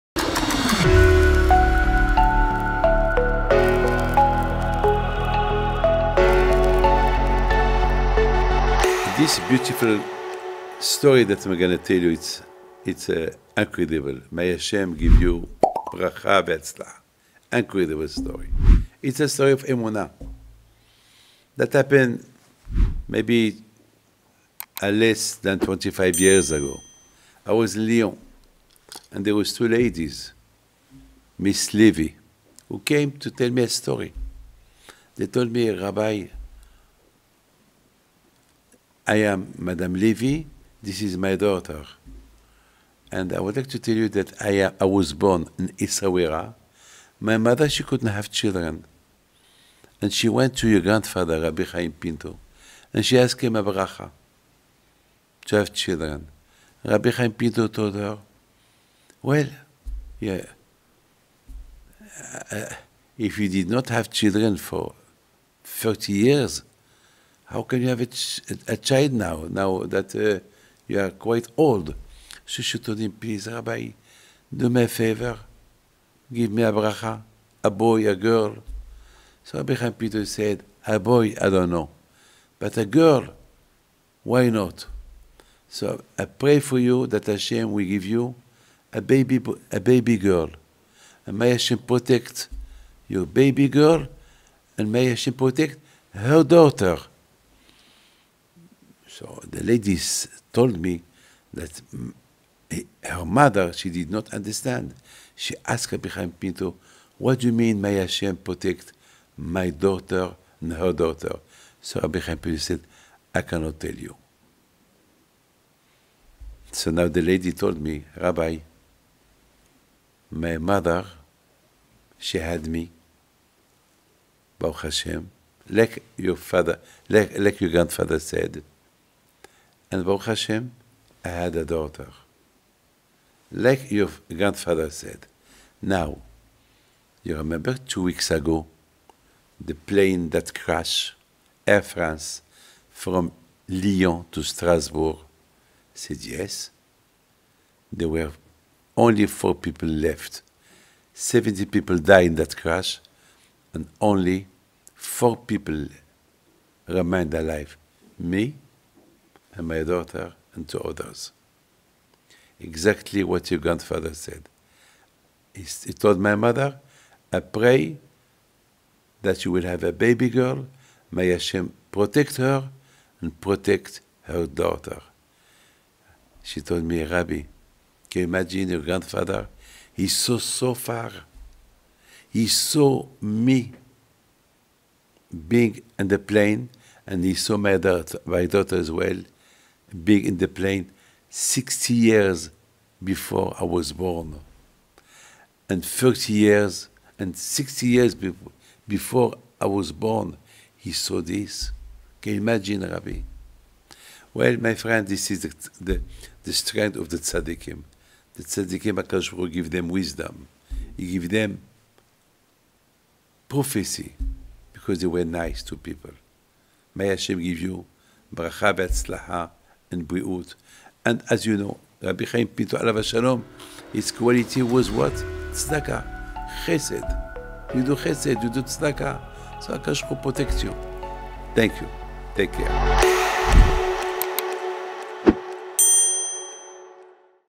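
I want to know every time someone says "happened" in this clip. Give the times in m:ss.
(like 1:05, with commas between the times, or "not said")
0:21.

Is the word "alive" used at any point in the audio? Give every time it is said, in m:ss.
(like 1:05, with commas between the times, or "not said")
2:37.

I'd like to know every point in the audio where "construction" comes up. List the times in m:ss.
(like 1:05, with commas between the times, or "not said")
not said.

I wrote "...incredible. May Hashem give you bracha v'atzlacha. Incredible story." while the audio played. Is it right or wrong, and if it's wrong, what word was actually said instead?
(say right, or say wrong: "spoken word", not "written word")
right.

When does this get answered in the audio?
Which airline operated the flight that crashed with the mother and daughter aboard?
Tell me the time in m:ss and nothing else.
2:21.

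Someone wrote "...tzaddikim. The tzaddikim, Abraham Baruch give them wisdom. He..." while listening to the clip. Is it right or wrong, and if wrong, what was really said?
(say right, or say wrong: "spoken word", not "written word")
wrong: "HaKadosh", not "Abraham".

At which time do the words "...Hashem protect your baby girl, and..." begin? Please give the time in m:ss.
1:31.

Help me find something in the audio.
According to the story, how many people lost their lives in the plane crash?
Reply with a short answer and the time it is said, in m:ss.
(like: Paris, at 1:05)
70, at 2:31.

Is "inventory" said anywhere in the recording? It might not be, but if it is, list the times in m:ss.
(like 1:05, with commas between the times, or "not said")
not said.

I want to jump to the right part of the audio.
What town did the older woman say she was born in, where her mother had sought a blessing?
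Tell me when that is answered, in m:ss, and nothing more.
0:45.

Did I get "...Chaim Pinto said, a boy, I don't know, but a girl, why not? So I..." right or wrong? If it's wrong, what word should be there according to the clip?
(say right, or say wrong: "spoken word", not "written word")
right.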